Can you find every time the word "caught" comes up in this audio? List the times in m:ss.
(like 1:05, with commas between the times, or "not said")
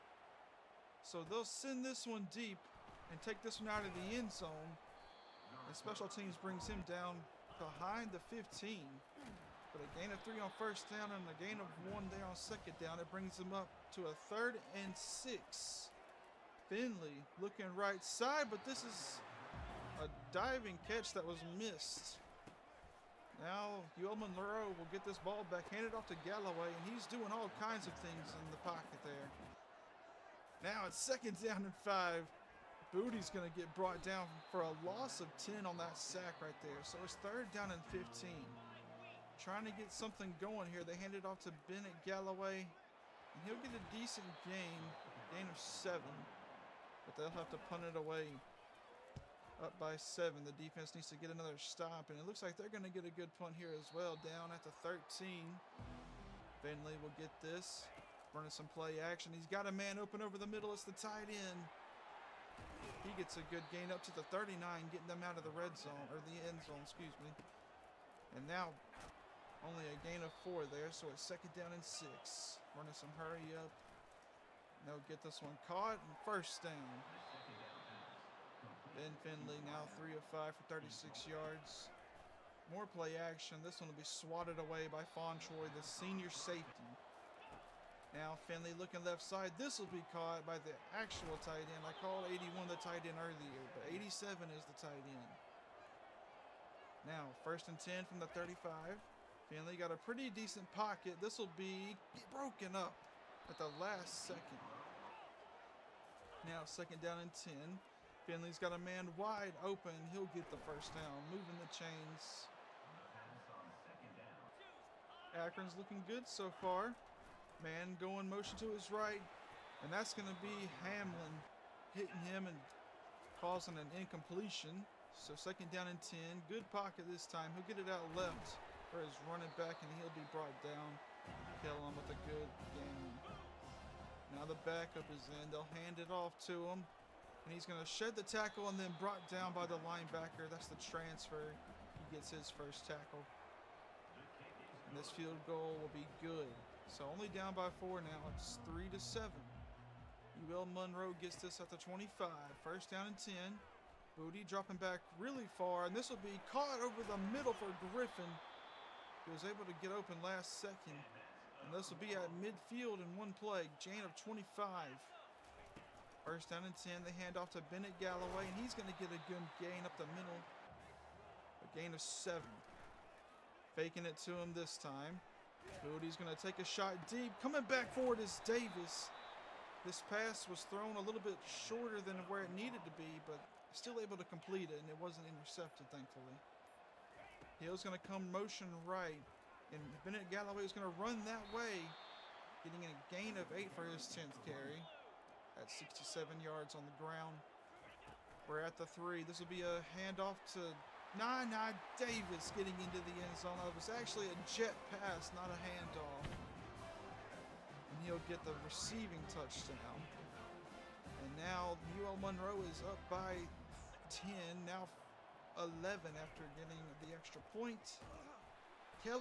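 1:15, 1:30, 2:36.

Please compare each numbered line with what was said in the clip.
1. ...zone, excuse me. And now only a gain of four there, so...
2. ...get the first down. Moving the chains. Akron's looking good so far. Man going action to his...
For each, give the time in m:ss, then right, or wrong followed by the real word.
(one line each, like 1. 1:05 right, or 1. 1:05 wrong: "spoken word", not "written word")
1. 1:06 right
2. 1:50 wrong: "motion", not "action".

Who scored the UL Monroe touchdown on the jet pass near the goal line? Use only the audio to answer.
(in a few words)
Nana Davis.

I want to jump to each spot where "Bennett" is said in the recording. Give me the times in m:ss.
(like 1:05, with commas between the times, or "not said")
0:41, 2:47, 3:10.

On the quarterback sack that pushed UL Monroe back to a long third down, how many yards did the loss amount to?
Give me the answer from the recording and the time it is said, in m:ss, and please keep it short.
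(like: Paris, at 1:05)
10, at 0:34.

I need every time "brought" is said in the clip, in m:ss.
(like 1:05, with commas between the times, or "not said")
0:33, 2:10, 2:18.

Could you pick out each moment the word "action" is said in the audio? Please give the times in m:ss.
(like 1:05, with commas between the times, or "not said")
0:58, 1:23.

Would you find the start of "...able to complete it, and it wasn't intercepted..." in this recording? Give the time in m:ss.
3:04.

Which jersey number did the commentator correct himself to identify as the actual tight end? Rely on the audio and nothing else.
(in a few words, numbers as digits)
87.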